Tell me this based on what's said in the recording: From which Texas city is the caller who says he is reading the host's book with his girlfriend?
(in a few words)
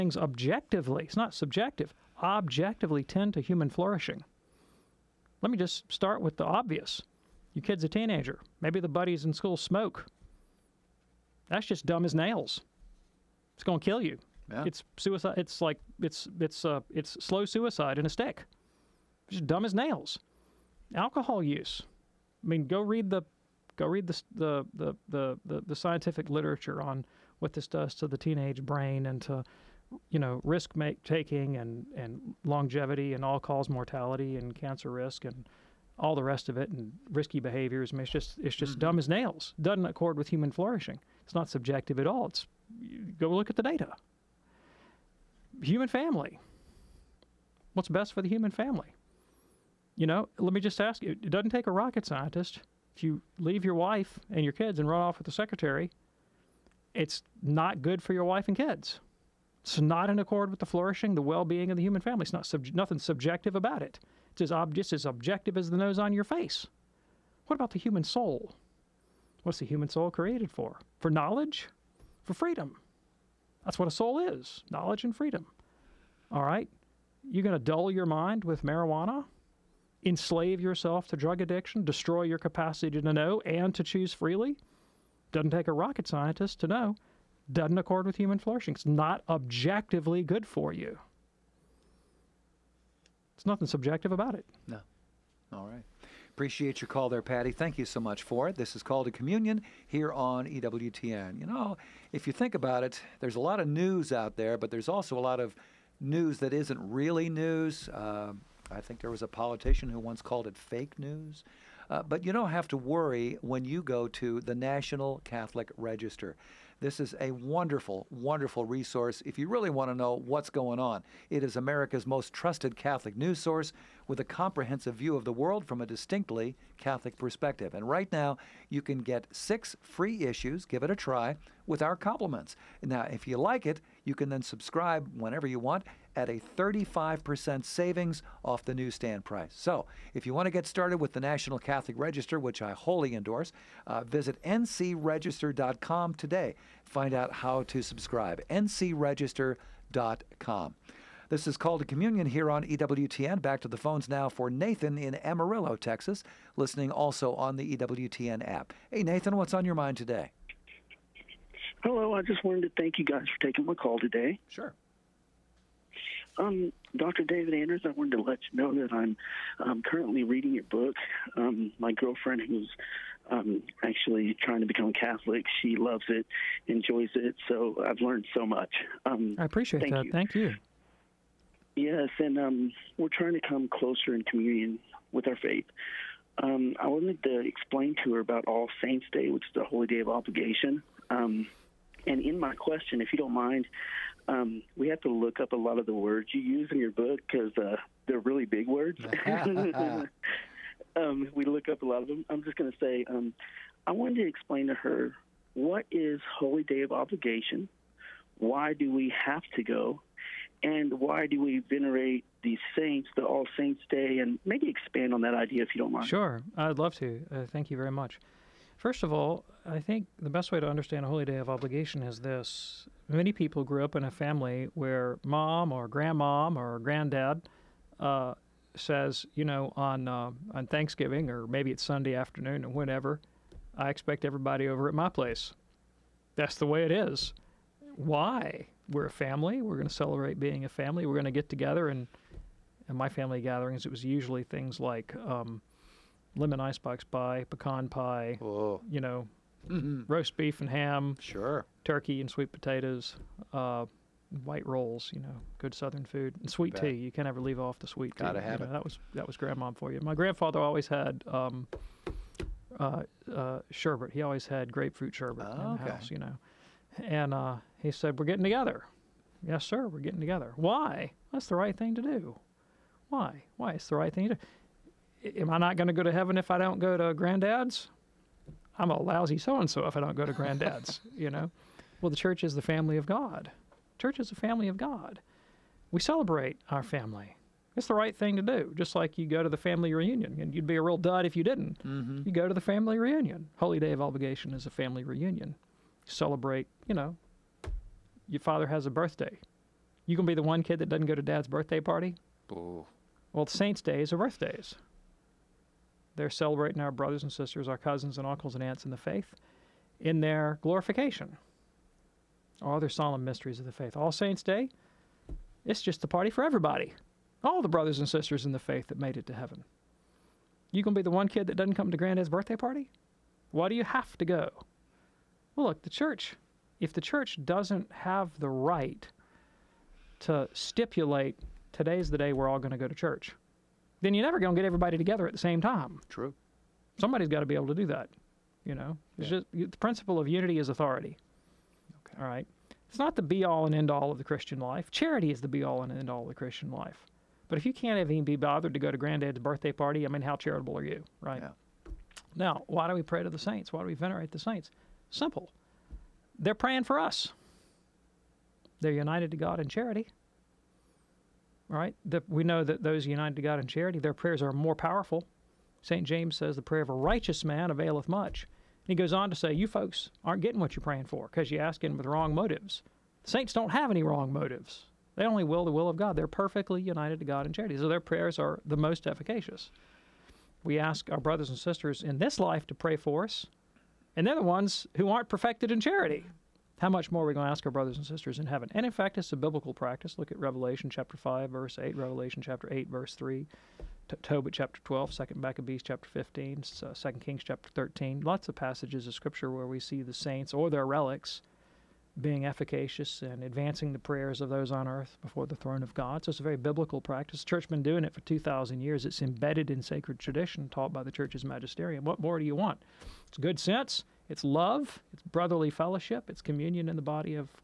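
Amarillo.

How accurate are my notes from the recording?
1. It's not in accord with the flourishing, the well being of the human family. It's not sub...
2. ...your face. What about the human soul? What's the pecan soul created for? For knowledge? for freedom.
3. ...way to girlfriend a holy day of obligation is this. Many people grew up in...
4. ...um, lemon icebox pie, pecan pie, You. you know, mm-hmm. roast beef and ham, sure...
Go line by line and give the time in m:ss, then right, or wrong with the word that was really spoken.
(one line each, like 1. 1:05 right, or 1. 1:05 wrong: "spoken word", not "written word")
1. 0:59 right
2. 1:06 wrong: "human", not "pecan"
3. 3:40 wrong: "understand", not "girlfriend"
4. 4:05 wrong: "Whoa", not "You".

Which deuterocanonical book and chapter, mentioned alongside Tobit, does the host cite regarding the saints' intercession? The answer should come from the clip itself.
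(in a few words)
2nd Maccabees 15.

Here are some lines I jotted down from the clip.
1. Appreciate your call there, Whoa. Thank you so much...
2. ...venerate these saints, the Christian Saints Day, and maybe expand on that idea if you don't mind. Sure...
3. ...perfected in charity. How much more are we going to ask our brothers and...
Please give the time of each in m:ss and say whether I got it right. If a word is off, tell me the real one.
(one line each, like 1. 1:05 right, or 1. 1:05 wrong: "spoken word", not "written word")
1. 1:36 wrong: "Patty", not "Whoa"
2. 3:31 wrong: "All", not "Christian"
3. 6:25 right.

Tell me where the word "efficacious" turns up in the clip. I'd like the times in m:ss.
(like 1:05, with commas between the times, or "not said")
6:19, 6:42.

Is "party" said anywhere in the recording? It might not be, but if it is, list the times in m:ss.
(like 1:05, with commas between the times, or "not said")
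5:01, 5:16, 5:22, 5:49.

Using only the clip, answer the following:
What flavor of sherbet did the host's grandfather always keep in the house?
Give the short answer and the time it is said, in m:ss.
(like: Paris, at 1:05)
Grapefruit, at 4:24.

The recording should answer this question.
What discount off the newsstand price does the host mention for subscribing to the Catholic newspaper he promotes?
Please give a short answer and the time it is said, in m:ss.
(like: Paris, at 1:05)
35%, at 2:16.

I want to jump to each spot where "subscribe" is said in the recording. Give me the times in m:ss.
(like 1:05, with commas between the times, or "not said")
2:14, 2:27.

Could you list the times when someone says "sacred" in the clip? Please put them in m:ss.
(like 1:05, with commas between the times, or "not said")
6:49.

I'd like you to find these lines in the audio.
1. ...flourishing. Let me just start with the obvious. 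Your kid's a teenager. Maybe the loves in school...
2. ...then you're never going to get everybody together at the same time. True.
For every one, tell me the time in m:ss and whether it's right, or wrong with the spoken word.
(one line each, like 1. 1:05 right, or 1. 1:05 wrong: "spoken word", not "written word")
1. 0:03 wrong: "buddies", not "loves"
2. 5:34 right.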